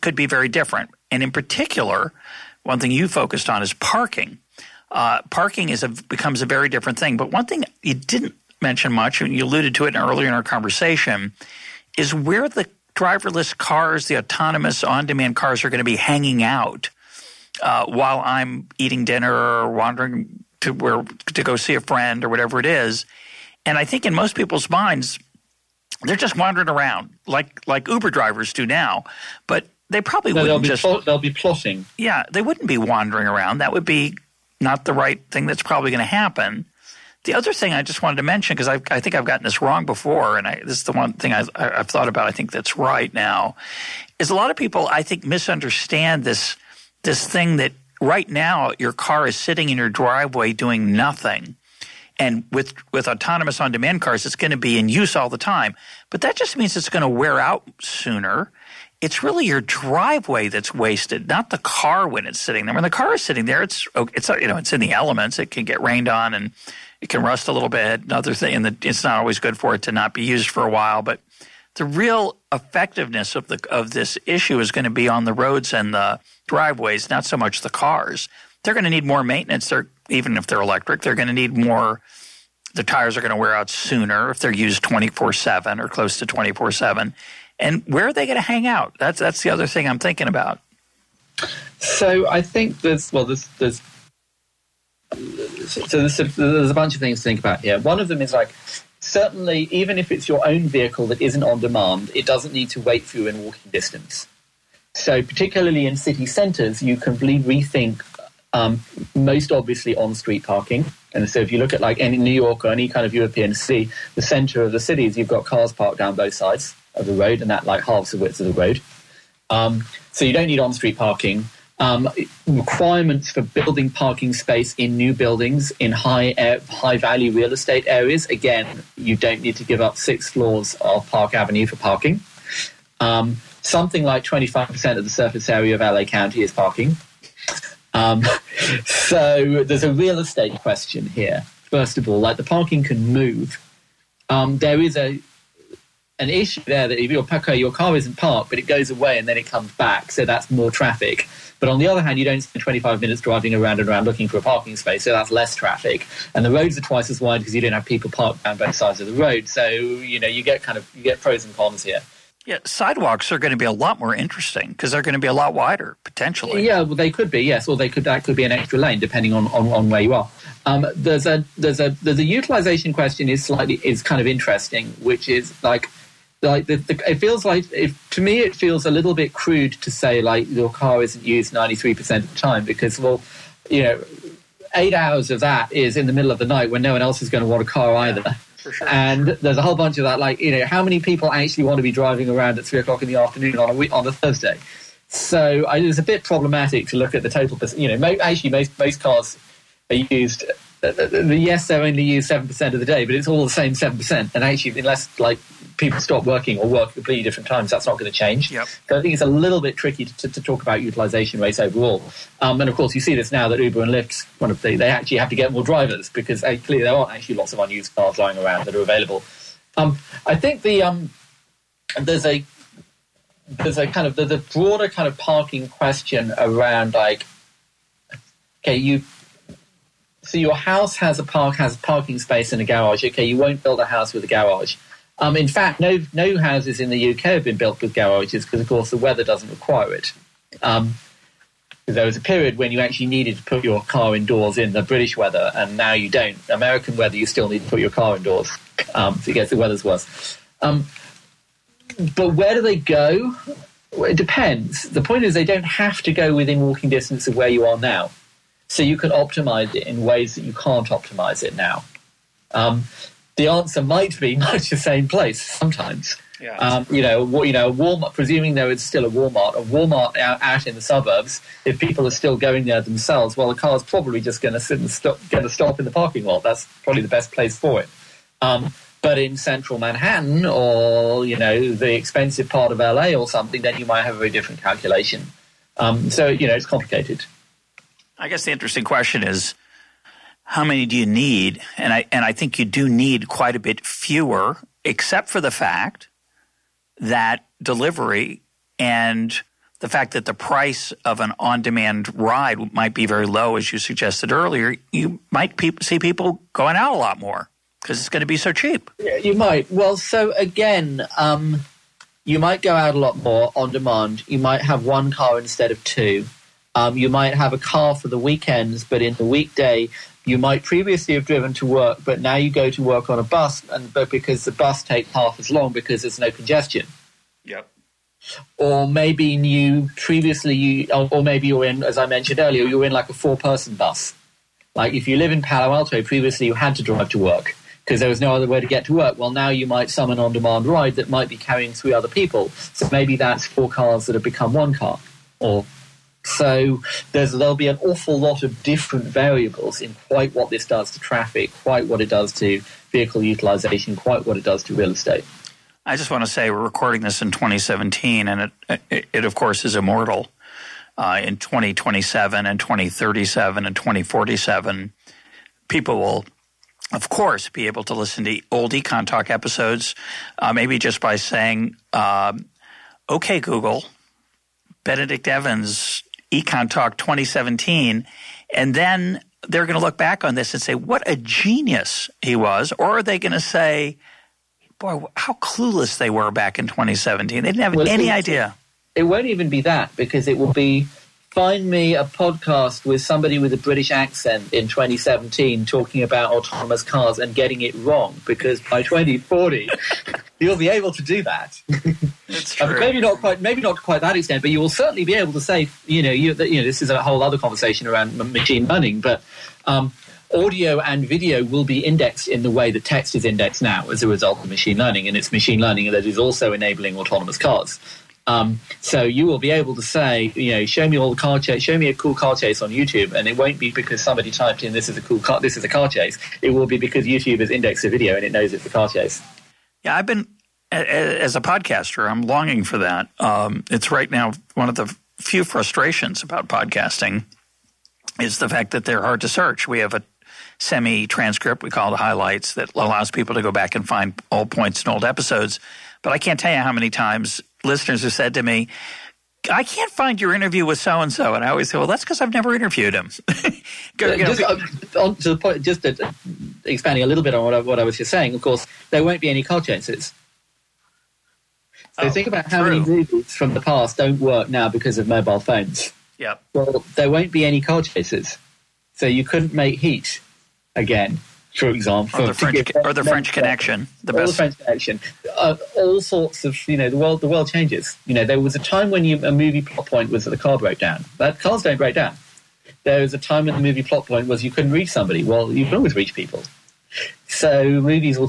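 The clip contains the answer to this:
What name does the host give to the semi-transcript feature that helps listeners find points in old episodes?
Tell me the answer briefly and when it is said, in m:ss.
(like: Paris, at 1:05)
highlights, at 7:21.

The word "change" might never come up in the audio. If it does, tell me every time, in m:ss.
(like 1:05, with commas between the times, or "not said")
3:28, 7:57.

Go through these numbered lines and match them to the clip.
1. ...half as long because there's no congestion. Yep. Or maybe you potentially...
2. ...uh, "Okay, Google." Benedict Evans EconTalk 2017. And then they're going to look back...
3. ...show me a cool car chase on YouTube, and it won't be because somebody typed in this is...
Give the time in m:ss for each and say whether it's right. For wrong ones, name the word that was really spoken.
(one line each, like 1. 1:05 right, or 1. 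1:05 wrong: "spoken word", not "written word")
1. 5:25 wrong: "previously", not "potentially"
2. 6:11 right
3. 7:01 right.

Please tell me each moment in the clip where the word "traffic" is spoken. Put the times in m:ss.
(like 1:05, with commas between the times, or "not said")
2:30, 2:35, 5:50.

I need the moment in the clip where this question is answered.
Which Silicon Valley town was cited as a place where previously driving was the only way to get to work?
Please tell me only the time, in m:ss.
5:35.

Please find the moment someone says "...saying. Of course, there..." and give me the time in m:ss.
7:38.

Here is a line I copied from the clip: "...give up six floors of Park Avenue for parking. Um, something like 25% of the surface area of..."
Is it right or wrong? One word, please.
right.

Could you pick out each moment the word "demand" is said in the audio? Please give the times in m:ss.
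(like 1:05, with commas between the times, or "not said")
0:14, 0:53, 1:41, 5:01, 5:13, 5:40.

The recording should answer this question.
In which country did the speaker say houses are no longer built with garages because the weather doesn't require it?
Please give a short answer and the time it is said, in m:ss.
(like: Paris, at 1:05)
UK, at 3:57.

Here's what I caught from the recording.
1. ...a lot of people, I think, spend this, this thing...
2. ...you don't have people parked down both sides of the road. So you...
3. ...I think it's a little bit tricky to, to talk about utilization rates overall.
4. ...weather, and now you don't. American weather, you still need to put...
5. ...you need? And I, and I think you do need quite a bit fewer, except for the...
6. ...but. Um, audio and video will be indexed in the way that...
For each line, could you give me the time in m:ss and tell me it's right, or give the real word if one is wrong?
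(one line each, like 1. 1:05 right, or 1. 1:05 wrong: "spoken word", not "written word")
1. 0:44 wrong: "misunderstand", not "spend"
2. 2:37 right
3. 3:28 right
4. 4:05 right
5. 4:50 right
6. 6:49 right.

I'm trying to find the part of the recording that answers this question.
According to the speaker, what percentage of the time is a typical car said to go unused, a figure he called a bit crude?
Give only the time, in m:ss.
3:01.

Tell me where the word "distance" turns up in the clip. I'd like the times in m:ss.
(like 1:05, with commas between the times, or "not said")
1:43, 4:16.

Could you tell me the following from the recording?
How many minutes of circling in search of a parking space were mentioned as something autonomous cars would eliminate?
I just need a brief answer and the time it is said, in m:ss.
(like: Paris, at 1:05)
25 minutes, at 2:32.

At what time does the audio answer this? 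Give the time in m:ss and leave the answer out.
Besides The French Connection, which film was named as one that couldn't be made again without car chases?
7:49.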